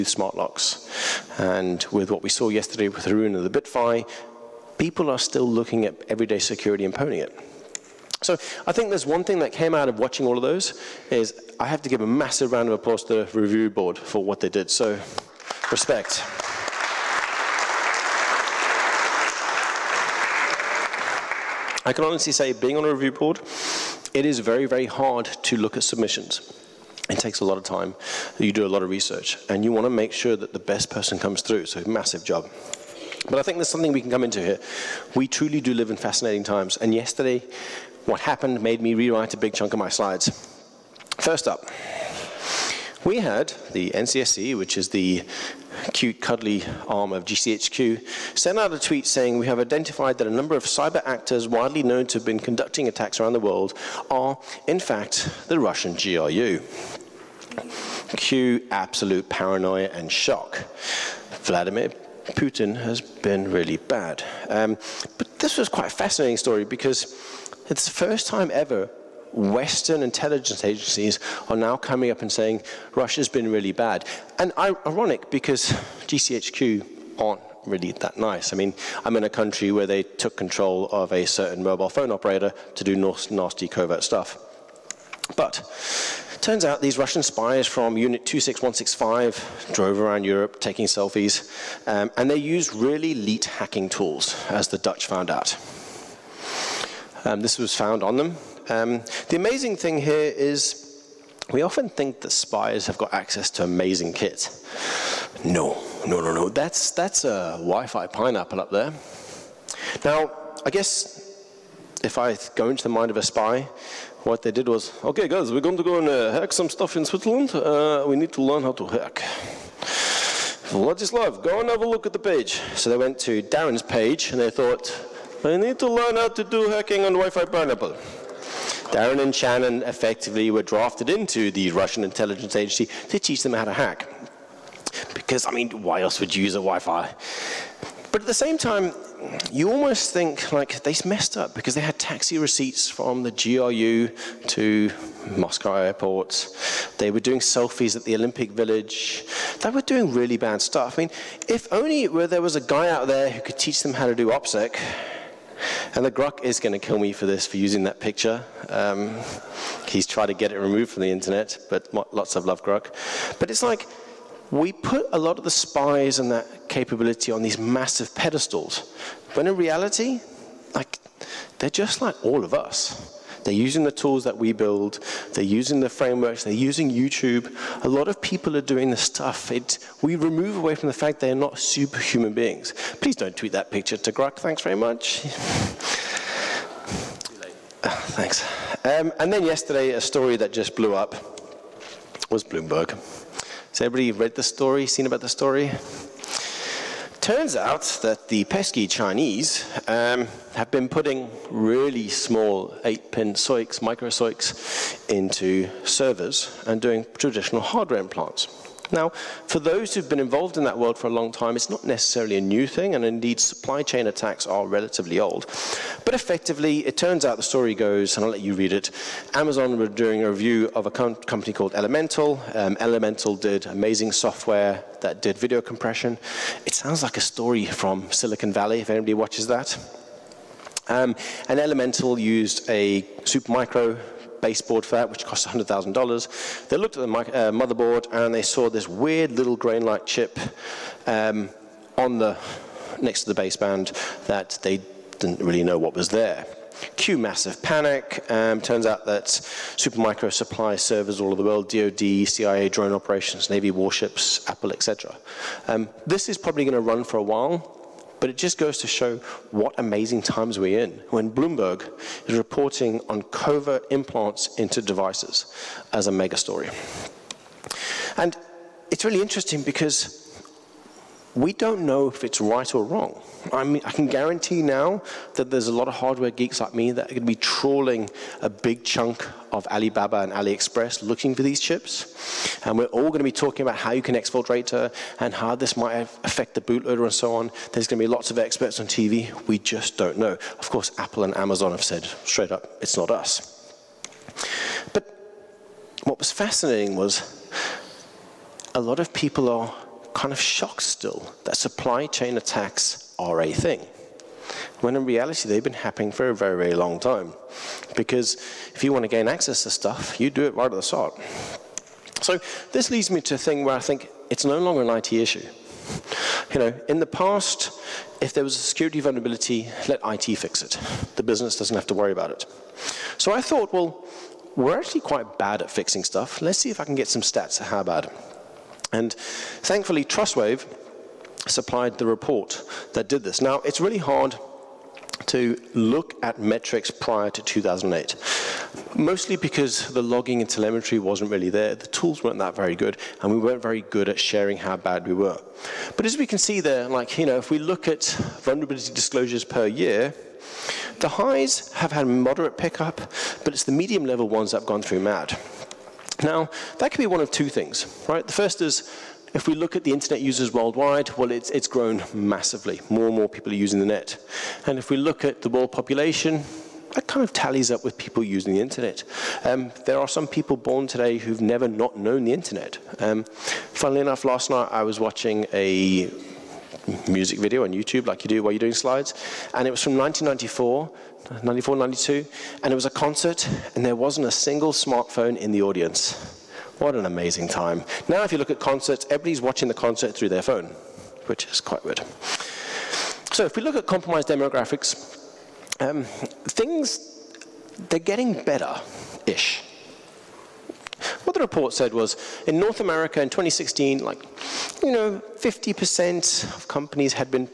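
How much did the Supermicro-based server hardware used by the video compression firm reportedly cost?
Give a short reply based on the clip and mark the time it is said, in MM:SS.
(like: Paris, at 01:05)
$100,000, at 03:55.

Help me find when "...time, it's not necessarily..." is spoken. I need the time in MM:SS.
03:31.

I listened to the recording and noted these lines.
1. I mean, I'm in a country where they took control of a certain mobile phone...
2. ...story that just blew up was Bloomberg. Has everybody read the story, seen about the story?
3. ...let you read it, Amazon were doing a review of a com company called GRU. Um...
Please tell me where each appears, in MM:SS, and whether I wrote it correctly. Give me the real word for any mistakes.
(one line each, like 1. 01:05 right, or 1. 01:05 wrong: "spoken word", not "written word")
1. 01:18 right
2. 03:10 right
3. 03:38 wrong: "Elemental", not "GRU".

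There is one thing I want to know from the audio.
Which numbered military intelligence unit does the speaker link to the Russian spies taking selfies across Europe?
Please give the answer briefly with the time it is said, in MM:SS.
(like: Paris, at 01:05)
Unit 26165, at 01:27.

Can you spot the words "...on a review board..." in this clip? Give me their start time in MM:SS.
00:22.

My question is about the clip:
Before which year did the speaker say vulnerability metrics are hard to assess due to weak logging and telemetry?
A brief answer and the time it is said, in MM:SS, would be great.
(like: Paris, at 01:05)
2008, at 05:37.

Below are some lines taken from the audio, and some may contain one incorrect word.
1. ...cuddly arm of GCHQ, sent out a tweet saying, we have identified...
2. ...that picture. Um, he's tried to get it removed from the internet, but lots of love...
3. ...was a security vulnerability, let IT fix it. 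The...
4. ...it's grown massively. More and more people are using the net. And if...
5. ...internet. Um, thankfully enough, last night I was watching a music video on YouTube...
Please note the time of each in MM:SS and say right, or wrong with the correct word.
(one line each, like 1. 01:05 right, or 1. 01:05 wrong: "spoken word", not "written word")
1. 00:46 right
2. 02:37 right
3. 05:18 right
4. 06:01 right
5. 06:12 wrong: "funnily", not "thankfully".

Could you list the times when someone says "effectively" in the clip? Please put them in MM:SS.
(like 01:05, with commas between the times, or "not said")
02:09, 03:36.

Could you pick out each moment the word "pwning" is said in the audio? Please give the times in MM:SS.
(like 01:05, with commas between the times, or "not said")
00:06.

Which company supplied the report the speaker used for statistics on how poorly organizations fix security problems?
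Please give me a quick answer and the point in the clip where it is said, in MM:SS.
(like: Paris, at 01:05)
Trustwave, at 05:30.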